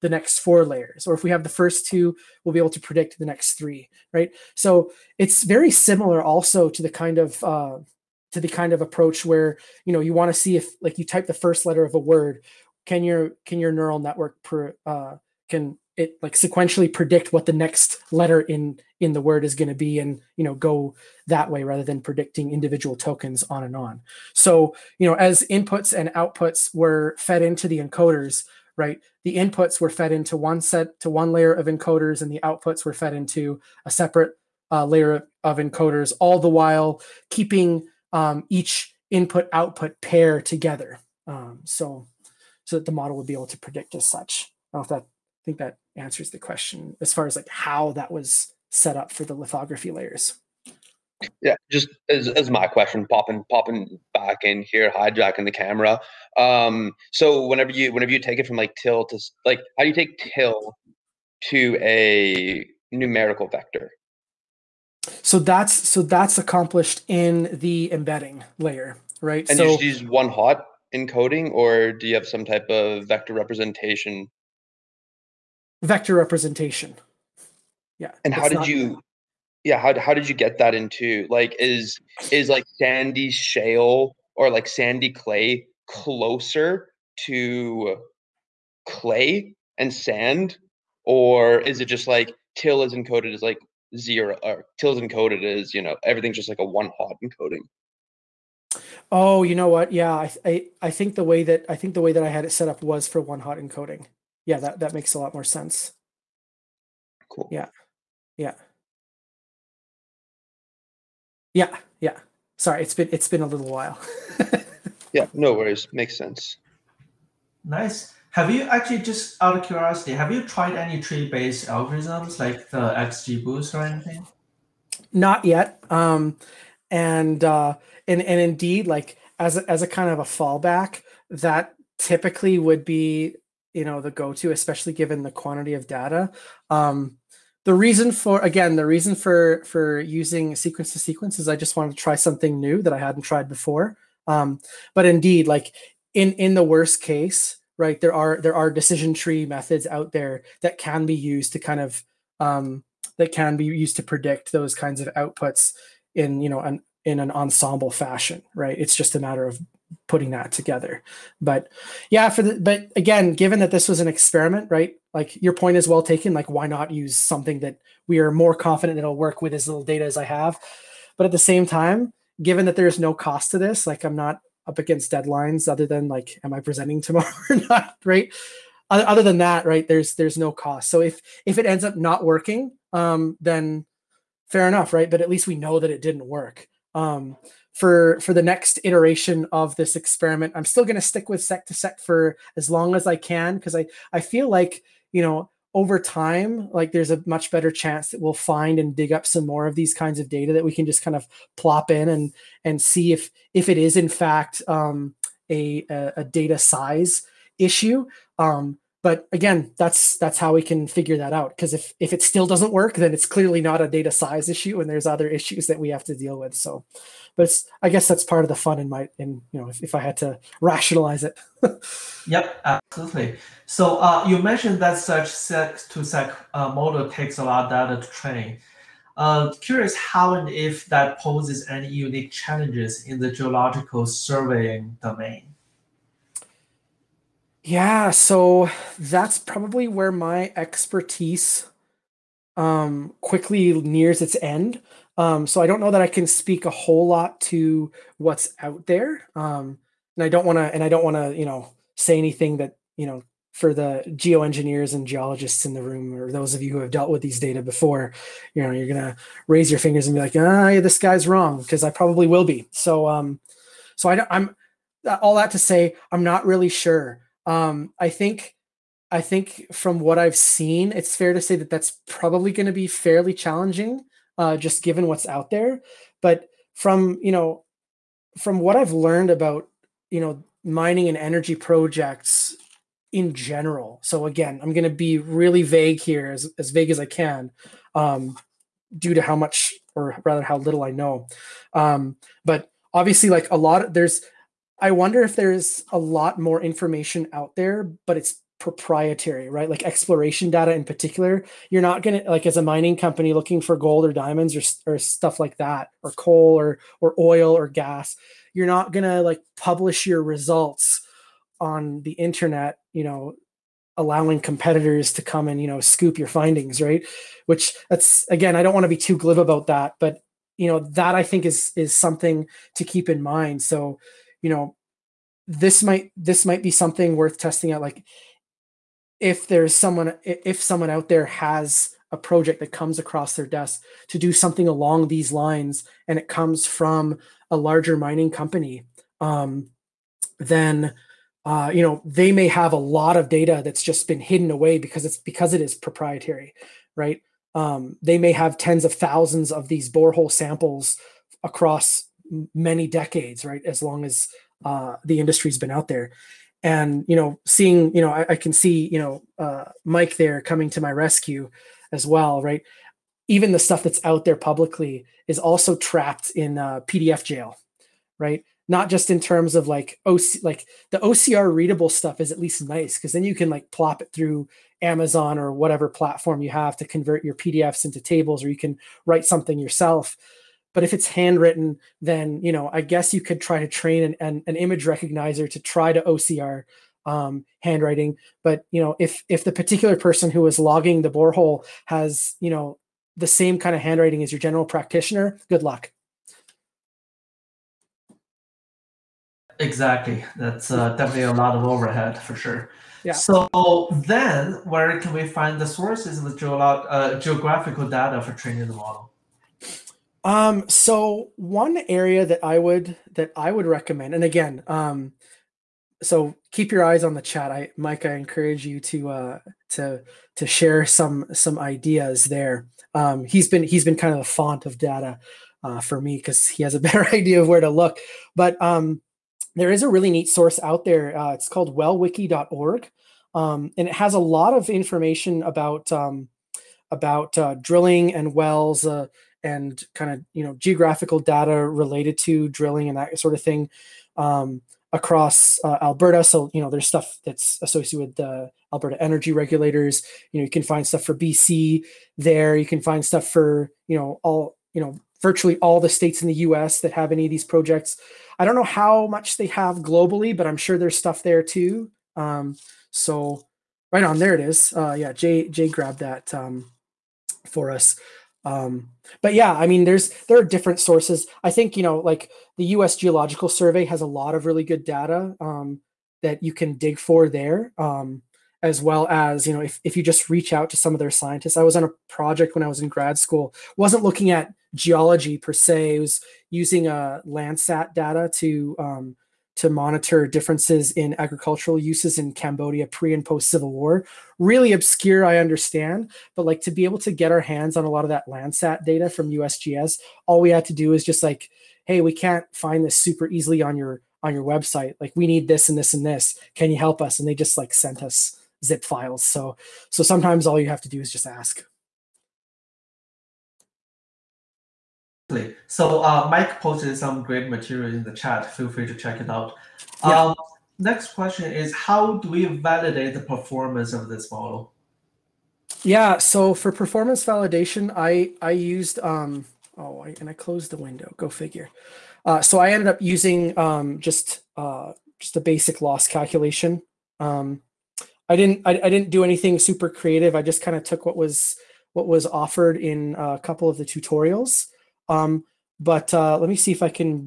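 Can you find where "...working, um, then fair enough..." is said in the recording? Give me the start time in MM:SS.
03:02.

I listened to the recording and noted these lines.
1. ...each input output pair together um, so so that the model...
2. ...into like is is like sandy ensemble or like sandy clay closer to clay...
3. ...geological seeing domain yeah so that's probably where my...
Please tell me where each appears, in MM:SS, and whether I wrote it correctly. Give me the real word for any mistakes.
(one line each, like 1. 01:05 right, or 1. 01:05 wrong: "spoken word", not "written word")
1. 00:38 right
2. 01:20 wrong: "shale", not "ensemble"
3. 03:53 wrong: "surveying", not "seeing".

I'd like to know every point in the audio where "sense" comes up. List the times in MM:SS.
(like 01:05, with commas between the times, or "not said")
01:45, 01:56.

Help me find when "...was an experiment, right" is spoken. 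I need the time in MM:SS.
02:43.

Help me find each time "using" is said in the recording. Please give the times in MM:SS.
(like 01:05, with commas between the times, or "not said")
02:19, 08:06, 08:53.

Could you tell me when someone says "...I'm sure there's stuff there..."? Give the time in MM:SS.
07:40.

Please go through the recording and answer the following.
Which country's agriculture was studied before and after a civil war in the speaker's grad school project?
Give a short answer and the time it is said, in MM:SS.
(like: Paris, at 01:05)
Cambodia, at 08:12.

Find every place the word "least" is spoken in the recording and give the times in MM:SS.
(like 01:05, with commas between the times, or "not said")
03:05, 06:12.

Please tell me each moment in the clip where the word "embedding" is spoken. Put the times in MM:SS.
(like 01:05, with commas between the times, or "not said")
01:07.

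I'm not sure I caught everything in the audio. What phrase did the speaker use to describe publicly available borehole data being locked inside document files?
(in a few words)
PDF jail.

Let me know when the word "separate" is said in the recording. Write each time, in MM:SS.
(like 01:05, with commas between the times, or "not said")
00:33.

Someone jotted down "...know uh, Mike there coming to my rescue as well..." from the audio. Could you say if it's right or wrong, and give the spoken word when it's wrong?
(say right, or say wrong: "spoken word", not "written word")
right.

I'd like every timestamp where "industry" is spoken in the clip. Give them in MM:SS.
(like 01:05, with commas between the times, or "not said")
05:55.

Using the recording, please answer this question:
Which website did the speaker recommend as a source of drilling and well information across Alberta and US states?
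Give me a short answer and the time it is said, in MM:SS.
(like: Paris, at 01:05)
wellwiki.org, at 07:11.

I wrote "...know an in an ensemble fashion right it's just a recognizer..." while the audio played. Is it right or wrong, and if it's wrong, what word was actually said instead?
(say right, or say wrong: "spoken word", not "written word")
wrong: "matter", not "recognizer".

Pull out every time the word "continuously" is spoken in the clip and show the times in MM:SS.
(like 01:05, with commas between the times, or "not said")
not said.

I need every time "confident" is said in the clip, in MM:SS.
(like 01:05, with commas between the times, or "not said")
02:48.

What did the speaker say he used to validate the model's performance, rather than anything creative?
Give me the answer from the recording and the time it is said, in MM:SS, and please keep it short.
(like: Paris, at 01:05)
Basic loss calculation, at 08:55.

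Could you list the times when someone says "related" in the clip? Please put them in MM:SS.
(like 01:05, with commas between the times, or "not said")
07:21.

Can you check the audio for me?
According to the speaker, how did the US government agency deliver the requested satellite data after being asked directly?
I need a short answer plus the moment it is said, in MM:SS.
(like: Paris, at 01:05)
Zip files, at 08:28.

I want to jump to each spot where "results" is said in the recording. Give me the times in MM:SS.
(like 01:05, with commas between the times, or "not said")
05:10.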